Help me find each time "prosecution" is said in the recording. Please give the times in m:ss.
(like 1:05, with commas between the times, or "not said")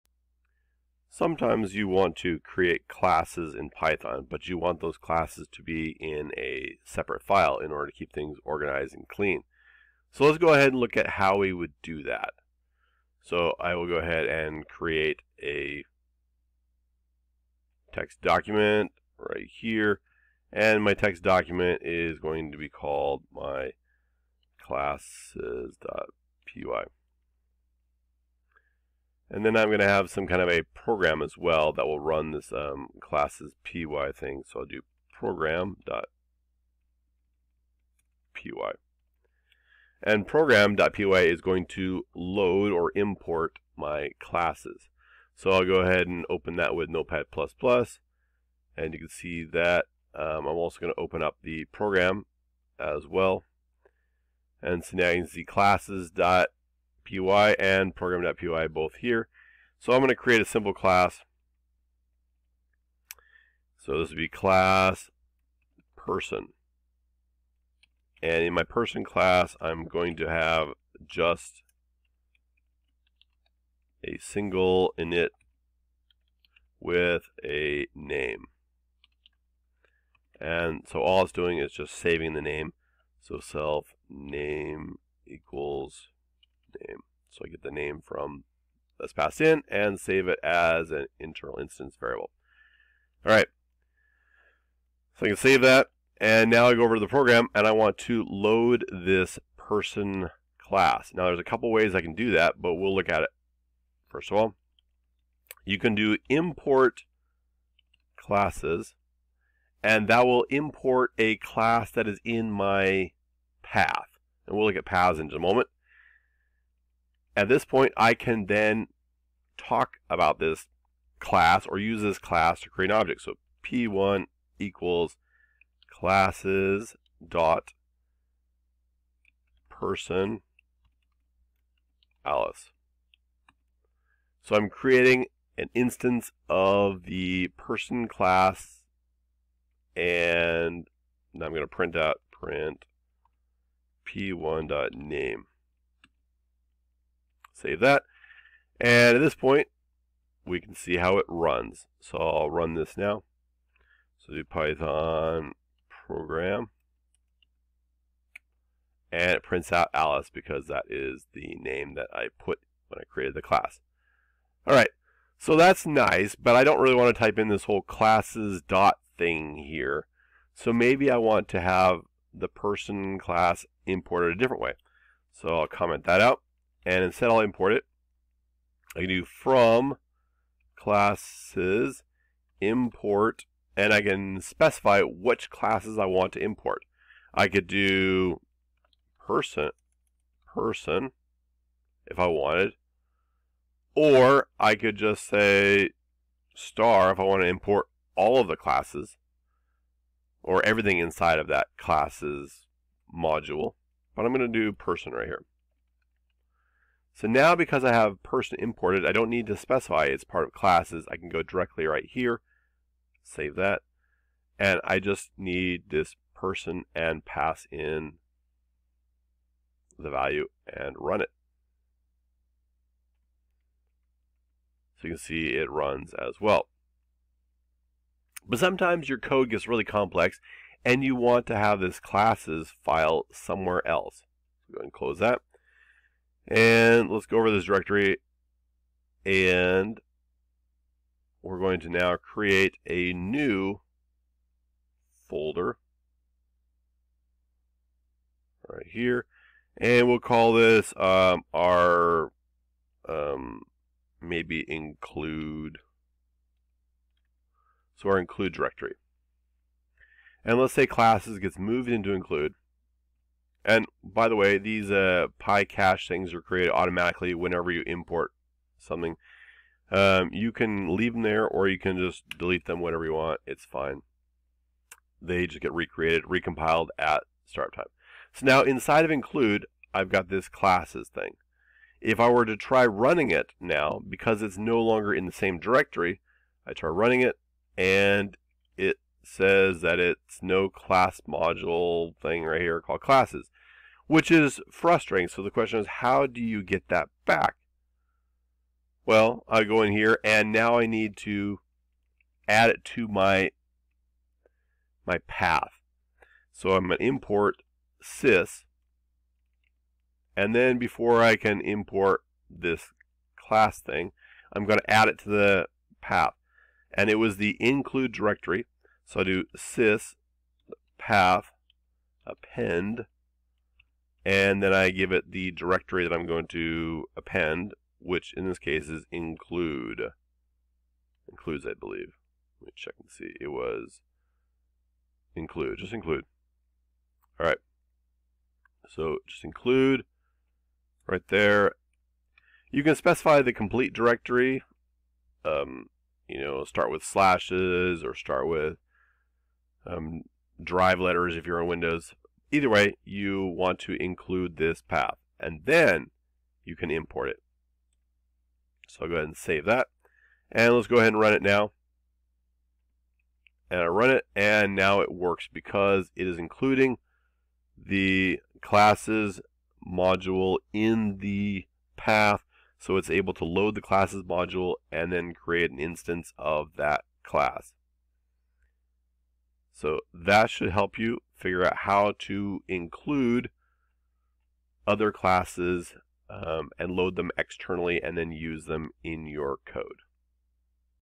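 not said.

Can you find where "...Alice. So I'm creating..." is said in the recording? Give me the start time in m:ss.
2:12.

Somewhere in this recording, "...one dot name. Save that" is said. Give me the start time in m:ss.
2:24.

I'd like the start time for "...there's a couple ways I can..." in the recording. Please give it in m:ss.
1:41.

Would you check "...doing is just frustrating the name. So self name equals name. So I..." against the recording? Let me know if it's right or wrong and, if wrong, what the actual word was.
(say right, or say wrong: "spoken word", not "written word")
wrong: "saving", not "frustrating".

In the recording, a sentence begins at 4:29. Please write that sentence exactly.
Um, you can leave them there or you can just delete them whenever you want.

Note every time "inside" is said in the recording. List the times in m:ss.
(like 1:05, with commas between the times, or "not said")
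3:20, 4:38.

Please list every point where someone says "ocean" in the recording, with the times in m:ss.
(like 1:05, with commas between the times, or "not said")
not said.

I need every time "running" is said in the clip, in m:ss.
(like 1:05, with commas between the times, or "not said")
4:42, 4:46.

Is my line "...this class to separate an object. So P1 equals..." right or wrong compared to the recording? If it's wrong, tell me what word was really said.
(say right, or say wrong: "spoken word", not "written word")
wrong: "create", not "separate".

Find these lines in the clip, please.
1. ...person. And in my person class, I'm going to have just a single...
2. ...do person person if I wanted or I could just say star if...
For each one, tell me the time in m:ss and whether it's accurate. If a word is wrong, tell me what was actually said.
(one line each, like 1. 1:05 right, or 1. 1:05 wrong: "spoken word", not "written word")
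1. 1:05 right
2. 3:07 right.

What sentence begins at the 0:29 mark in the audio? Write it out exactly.
And then I'm going to have some kind of a program as well that will run this um, classes py thing.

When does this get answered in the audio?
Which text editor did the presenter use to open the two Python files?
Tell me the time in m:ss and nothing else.
0:46.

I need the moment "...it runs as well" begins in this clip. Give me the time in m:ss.
3:45.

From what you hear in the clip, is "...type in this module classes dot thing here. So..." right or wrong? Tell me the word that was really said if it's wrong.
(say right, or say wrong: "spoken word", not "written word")
wrong: "whole", not "module".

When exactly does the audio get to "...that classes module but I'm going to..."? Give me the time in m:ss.
3:21.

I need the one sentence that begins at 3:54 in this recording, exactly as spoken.
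So go ahead and close that.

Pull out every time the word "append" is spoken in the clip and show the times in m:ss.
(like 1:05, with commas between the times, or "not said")
5:22, 5:27.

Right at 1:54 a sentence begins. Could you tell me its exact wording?
And we'll look at paths in just a moment.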